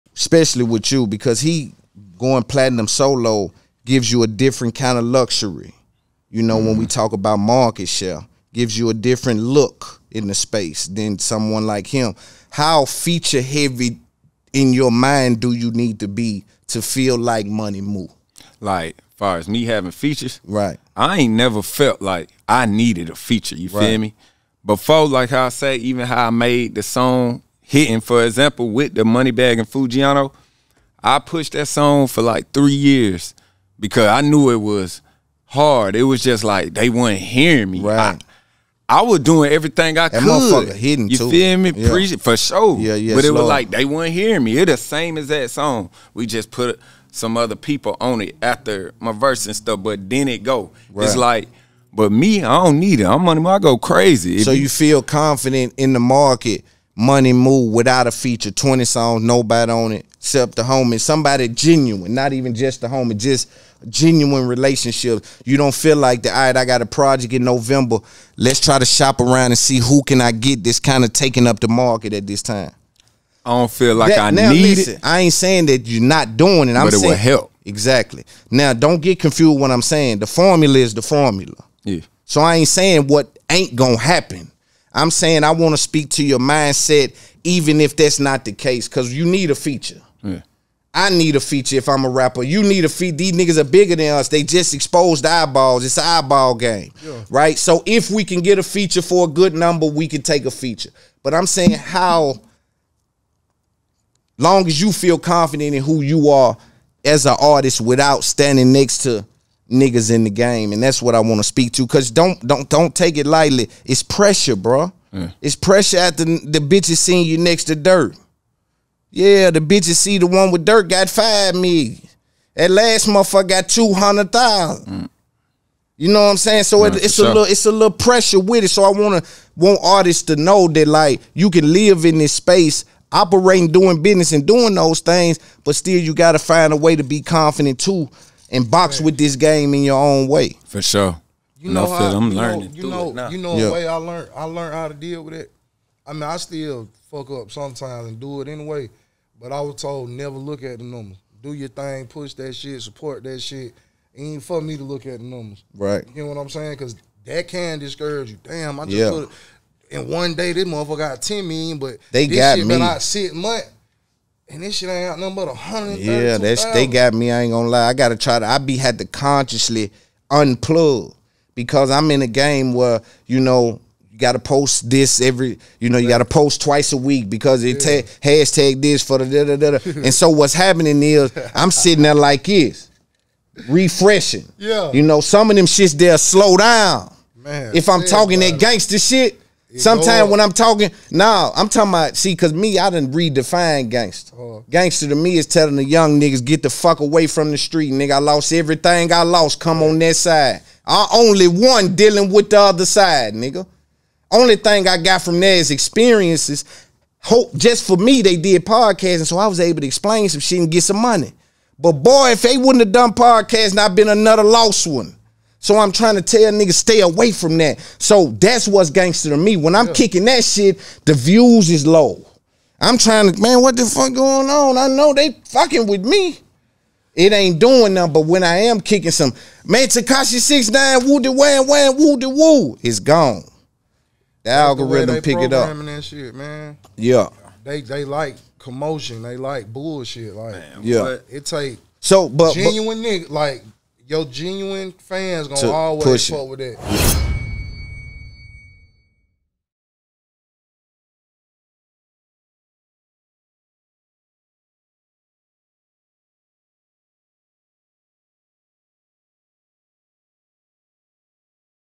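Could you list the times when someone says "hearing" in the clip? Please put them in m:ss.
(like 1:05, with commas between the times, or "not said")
0:37, 0:44.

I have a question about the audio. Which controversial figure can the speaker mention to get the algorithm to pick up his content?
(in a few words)
Tekashi 69.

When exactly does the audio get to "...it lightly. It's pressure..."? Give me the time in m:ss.
1:53.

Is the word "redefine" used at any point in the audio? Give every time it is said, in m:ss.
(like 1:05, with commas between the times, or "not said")
3:13.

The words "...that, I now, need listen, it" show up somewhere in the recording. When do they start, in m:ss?
1:14.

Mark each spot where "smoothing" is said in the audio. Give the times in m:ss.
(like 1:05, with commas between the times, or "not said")
not said.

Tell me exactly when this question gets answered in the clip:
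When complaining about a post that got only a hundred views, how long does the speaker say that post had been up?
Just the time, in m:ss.
2:43.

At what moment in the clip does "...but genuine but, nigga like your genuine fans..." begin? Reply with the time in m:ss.
4:02.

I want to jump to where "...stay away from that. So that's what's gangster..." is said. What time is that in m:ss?
3:36.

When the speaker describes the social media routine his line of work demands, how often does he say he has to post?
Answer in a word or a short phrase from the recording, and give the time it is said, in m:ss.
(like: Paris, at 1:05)
twice a week, at 2:56.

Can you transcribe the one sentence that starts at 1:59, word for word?
Yeah, the bitches see the one with Durk got five me.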